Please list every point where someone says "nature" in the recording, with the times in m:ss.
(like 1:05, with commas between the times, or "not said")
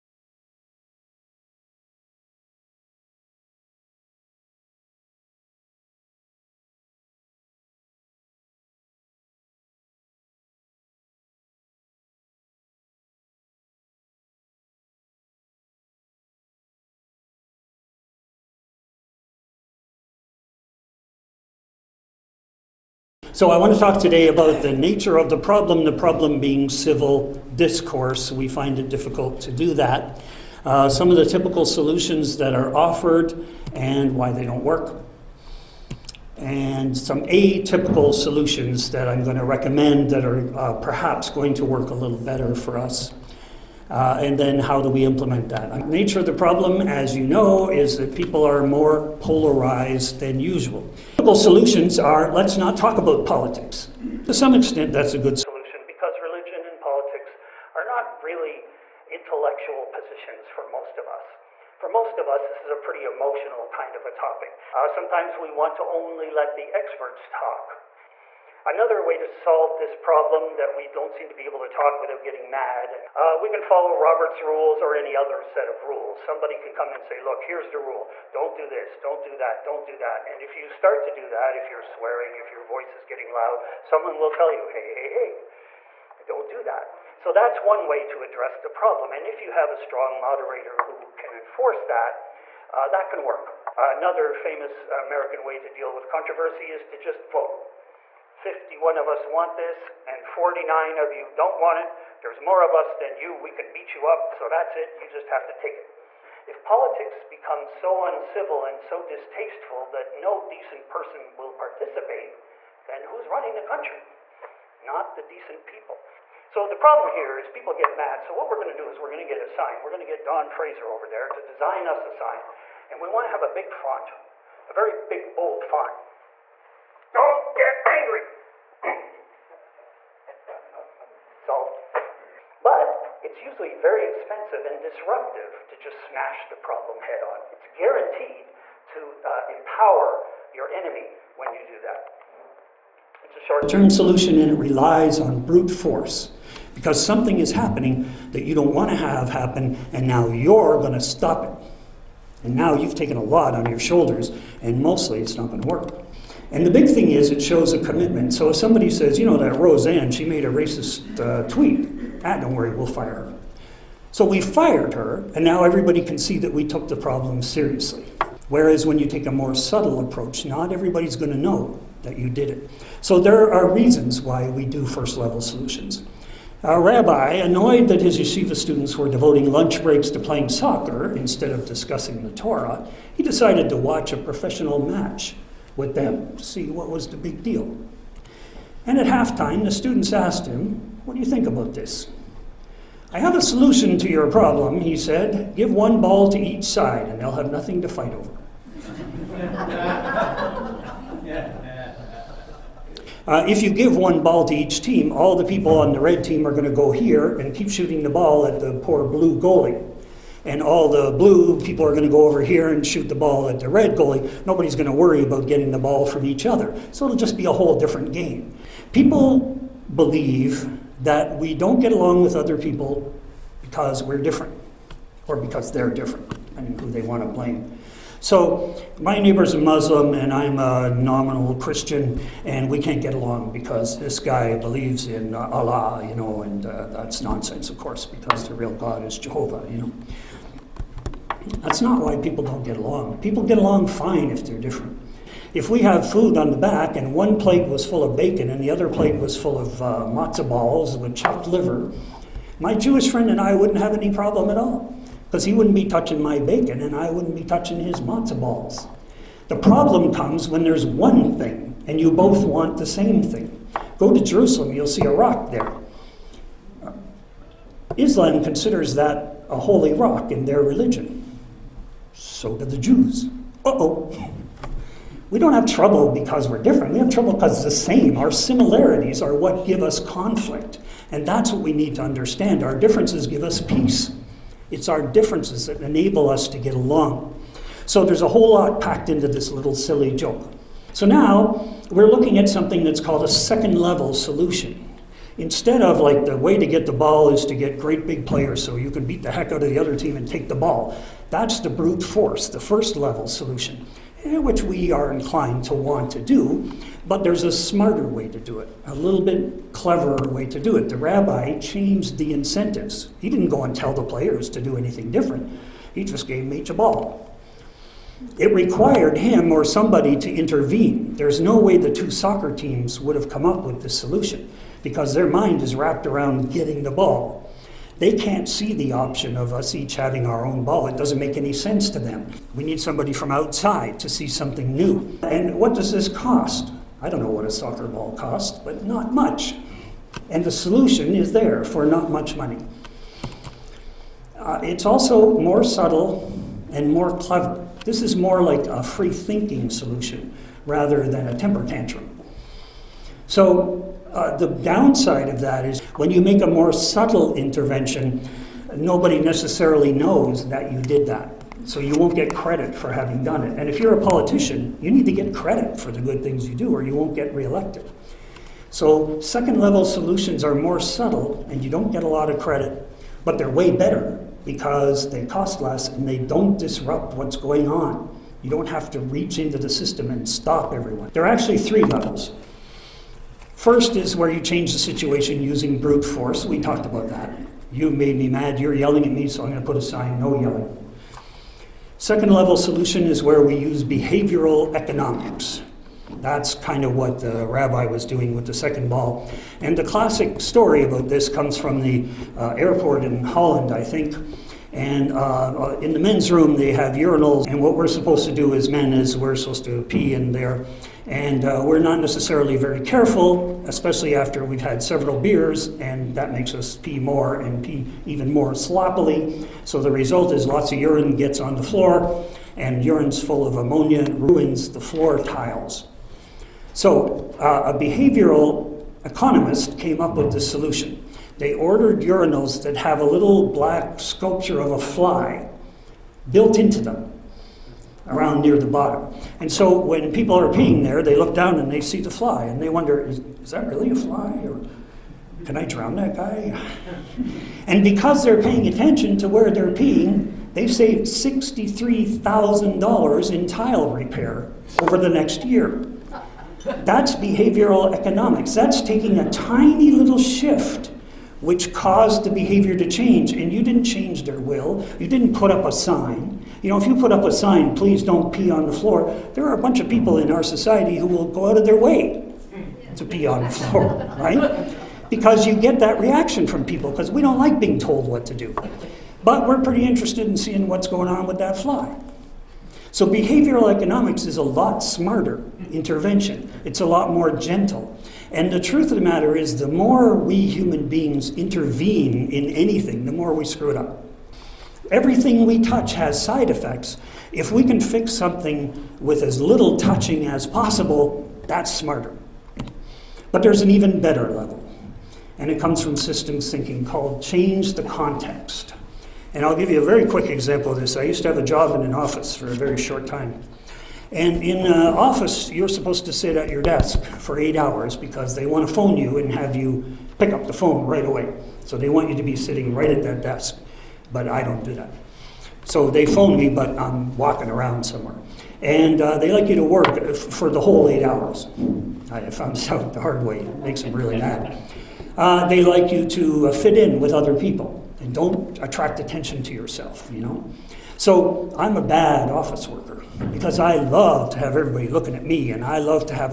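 0:24, 0:45.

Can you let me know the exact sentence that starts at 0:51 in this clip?
Typical solutions are let's not talk about politics.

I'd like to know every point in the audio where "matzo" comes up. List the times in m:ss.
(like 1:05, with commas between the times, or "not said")
4:10, 4:18.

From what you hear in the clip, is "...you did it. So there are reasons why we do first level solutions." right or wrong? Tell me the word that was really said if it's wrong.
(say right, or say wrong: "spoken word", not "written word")
right.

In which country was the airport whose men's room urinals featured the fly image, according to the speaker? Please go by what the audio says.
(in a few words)
Holland.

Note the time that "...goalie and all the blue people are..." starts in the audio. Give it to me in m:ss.
3:29.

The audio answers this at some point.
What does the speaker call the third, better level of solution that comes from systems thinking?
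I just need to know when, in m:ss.
8:27.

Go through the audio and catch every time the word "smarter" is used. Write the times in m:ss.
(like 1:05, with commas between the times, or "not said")
5:07, 8:04, 8:21.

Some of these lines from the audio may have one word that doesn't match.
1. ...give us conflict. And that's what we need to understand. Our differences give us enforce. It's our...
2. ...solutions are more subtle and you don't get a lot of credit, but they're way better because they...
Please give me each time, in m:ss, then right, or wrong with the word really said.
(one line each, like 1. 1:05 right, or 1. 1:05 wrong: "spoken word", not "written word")
1. 4:39 wrong: "peace", not "enforce"
2. 6:09 right.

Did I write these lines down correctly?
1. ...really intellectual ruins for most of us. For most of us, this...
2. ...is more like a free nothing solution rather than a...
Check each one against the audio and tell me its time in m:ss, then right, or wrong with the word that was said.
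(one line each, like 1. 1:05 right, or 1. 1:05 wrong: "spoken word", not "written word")
1. 0:58 wrong: "positions", not "ruins"
2. 5:48 wrong: "thinking", not "nothing".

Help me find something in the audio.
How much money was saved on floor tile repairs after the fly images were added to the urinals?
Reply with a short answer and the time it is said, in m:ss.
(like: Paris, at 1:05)
$63,000, at 7:31.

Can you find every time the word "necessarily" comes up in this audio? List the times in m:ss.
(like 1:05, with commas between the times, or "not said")
5:59, 6:51.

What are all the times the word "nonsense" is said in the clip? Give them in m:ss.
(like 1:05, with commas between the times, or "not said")
3:57.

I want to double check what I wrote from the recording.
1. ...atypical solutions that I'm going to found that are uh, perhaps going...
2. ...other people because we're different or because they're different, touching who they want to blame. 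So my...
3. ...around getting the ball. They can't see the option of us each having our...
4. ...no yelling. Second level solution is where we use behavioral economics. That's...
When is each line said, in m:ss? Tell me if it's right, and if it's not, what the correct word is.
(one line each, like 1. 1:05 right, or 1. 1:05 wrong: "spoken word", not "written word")
1. 0:37 wrong: "recommend", not "found"
2. 3:42 wrong: "depending", not "touching"
3. 5:26 right
4. 6:30 right.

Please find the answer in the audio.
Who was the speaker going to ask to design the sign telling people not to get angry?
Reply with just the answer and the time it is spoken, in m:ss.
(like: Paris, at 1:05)
Don Fraser, at 2:00.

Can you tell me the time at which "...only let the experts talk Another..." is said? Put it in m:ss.
1:05.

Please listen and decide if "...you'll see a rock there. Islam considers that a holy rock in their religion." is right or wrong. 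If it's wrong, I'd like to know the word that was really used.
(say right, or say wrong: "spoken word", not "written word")
right.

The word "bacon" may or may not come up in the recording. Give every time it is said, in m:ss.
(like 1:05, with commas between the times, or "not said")
4:08, 4:16.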